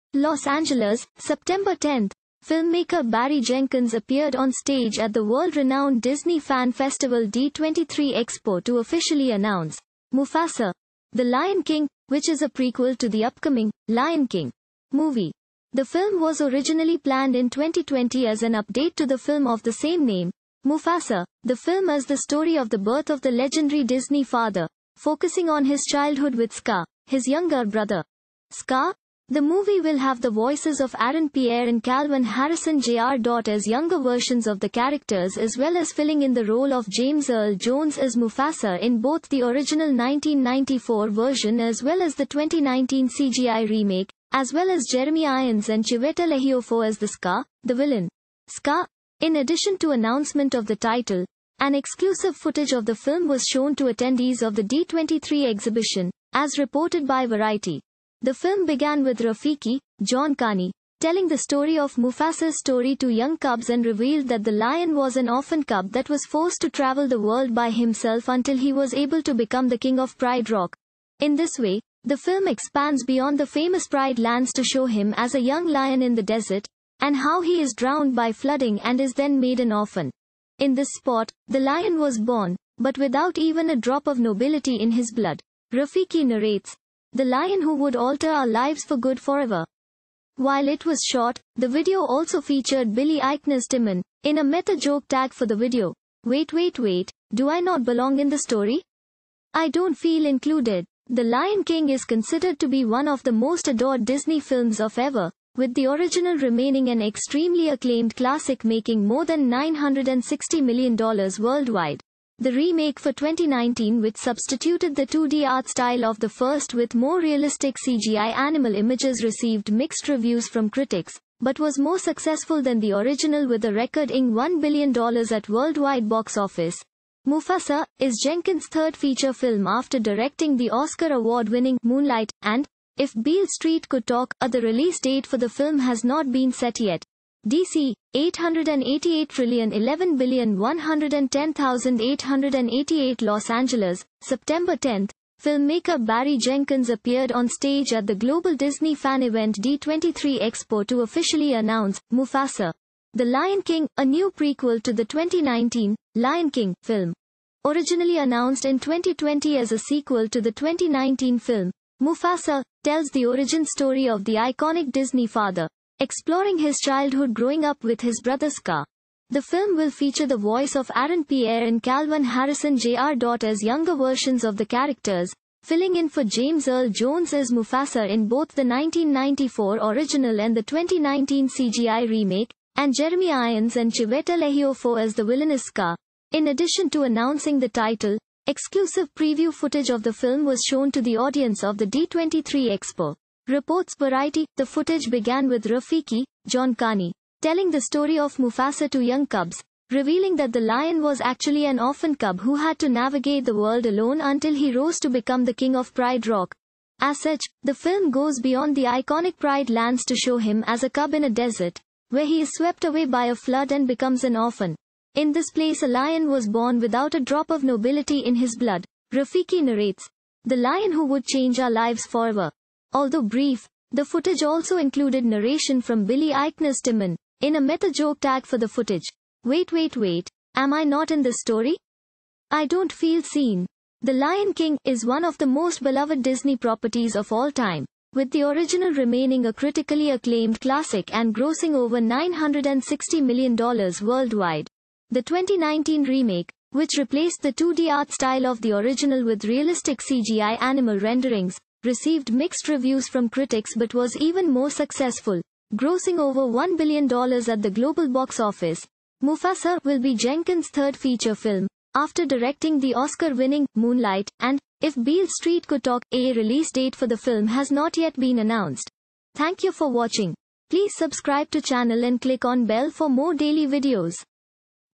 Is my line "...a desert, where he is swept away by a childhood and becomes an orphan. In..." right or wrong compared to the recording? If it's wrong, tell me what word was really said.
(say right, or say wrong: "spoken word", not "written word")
wrong: "flood", not "childhood".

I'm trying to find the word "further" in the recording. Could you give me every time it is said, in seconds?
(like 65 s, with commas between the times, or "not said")
not said.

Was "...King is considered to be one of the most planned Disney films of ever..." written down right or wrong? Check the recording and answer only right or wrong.
wrong.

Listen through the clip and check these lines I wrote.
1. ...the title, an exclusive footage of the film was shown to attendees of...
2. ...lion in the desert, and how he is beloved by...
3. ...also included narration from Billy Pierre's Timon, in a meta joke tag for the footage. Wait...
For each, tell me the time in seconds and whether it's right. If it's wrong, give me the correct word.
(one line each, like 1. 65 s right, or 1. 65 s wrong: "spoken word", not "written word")
1. 50 s right
2. 75 s wrong: "drowned", not "beloved"
3. 224 s wrong: "Eichner", not "Pierre".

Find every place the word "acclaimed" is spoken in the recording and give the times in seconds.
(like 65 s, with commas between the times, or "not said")
107 s, 240 s.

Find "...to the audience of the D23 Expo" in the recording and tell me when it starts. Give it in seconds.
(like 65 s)
190 s.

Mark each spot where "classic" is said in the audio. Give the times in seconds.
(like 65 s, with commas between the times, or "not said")
108 s, 240 s.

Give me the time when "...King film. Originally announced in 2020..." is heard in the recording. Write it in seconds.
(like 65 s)
156 s.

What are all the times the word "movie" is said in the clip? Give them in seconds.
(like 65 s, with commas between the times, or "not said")
14 s, 29 s.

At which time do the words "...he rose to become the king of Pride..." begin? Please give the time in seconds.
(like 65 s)
204 s.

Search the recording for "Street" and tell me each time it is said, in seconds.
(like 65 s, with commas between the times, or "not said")
133 s, 265 s.